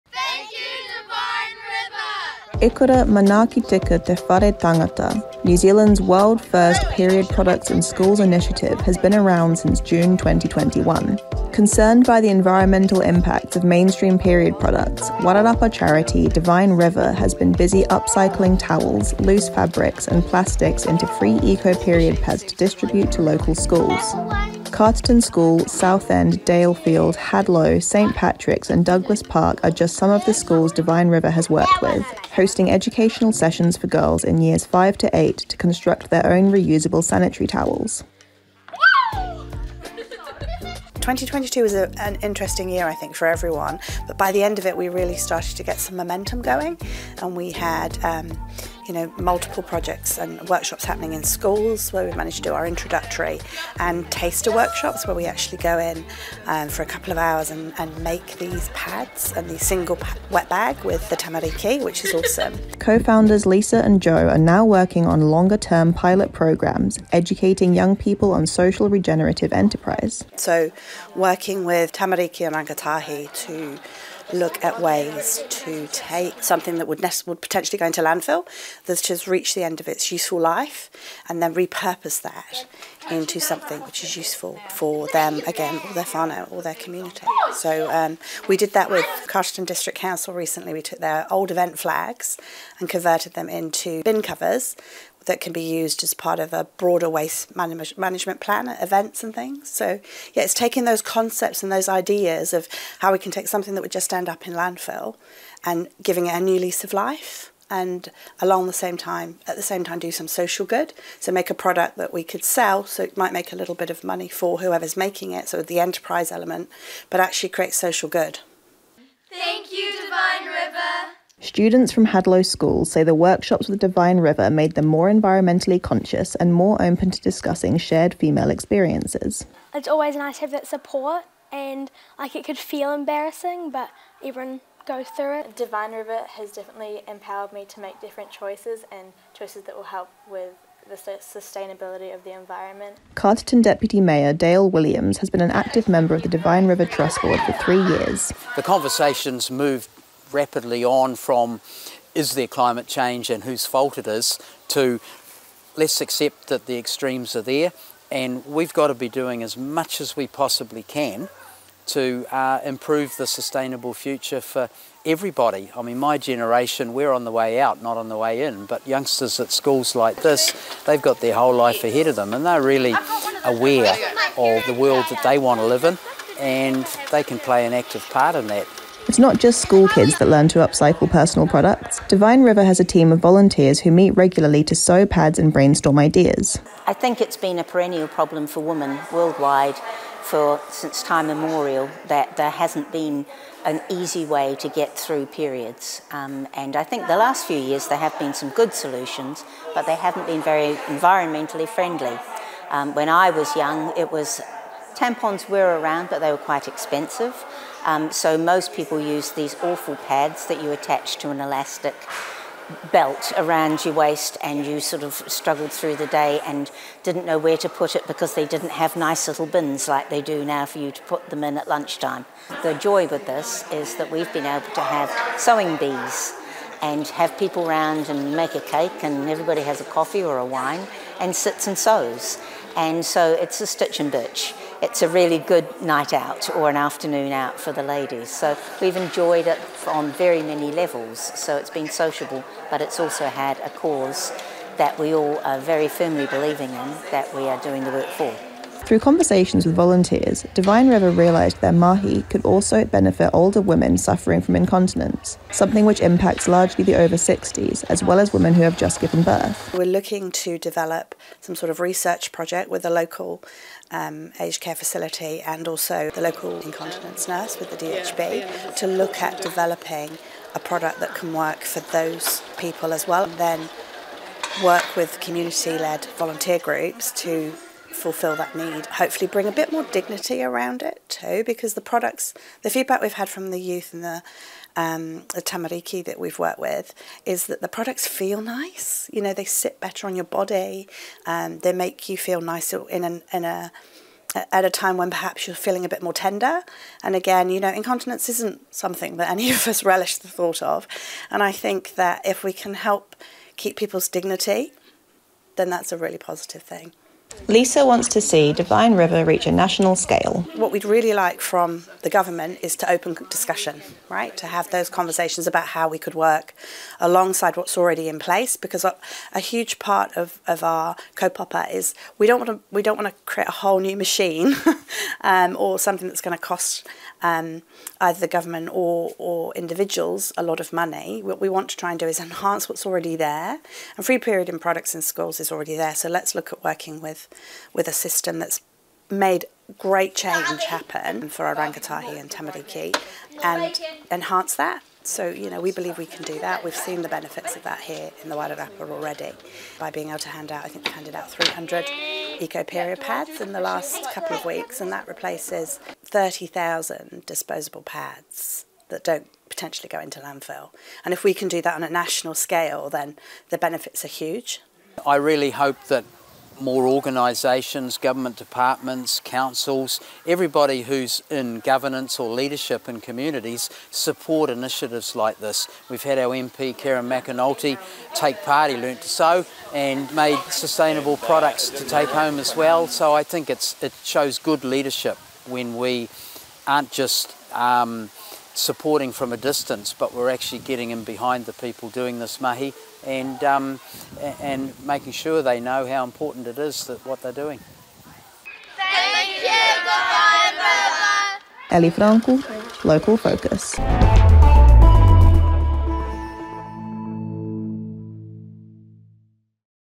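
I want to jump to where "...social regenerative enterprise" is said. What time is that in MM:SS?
01:08.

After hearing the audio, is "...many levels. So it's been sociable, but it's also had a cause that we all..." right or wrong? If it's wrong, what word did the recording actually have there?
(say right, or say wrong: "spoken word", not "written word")
right.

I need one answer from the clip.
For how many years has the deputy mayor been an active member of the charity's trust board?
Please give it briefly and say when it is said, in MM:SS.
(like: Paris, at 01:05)
3, at 02:27.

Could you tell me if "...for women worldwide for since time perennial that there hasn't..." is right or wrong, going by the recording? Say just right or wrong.
wrong.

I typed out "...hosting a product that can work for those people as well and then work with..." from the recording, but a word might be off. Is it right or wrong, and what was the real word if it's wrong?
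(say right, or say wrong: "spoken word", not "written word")
wrong: "developing", not "hosting".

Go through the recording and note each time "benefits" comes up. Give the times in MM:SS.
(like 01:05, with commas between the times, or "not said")
04:12, 05:47, 06:03.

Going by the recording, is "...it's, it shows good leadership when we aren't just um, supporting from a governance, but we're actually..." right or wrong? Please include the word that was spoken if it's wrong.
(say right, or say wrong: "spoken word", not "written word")
wrong: "distance", not "governance".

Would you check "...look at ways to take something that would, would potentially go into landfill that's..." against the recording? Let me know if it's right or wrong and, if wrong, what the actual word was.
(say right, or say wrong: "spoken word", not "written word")
right.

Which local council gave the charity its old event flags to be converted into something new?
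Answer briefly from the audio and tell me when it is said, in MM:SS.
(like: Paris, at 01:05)
Carterton District Council, at 01:29.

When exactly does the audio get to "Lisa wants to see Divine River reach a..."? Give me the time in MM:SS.
05:07.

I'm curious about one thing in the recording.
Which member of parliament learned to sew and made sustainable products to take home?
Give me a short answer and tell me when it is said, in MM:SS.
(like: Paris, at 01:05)
Kieran McAnulty, at 06:16.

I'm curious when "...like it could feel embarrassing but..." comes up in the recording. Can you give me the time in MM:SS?
02:12.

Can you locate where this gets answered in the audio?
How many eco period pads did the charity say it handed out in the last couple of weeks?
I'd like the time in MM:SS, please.
05:51.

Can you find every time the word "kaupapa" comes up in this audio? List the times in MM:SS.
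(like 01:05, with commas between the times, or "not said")
05:21.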